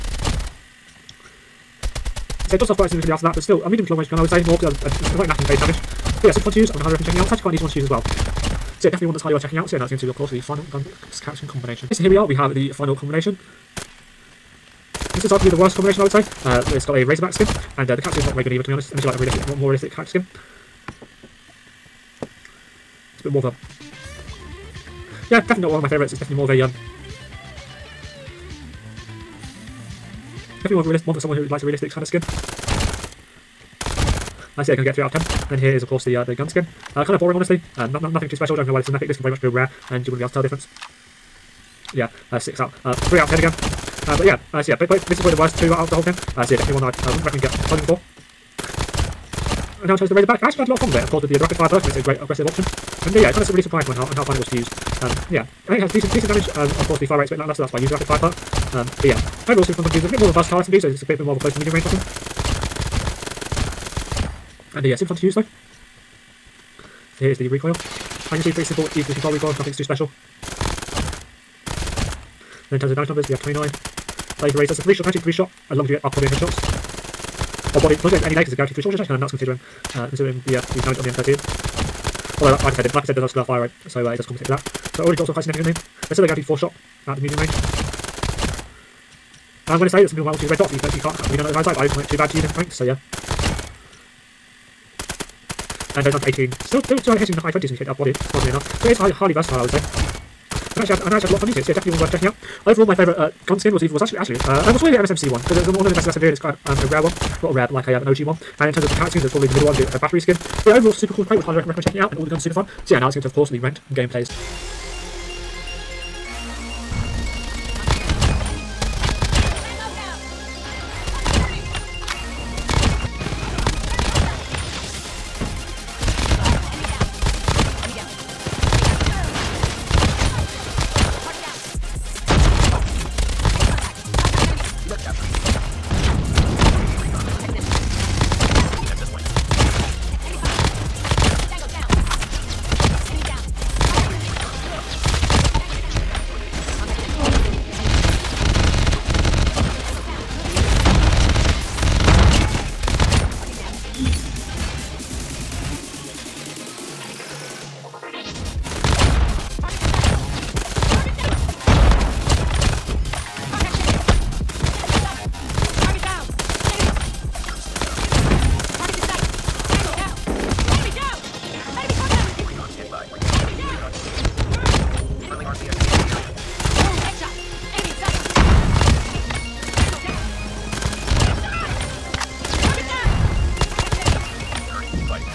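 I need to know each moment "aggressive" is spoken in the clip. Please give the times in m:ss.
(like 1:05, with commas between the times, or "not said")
0:52.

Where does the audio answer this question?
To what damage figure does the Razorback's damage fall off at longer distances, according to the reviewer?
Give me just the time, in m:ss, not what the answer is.
1:36.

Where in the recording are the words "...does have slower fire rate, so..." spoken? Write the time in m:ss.
1:23.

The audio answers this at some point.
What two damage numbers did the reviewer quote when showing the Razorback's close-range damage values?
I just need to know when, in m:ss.
1:13.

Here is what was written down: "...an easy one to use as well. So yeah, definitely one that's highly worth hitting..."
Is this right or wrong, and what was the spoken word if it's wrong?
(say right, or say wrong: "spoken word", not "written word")
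wrong: "checking", not "hitting".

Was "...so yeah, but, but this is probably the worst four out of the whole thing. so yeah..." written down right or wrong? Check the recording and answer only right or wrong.
wrong.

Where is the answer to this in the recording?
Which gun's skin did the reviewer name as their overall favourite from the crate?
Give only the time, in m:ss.
1:44.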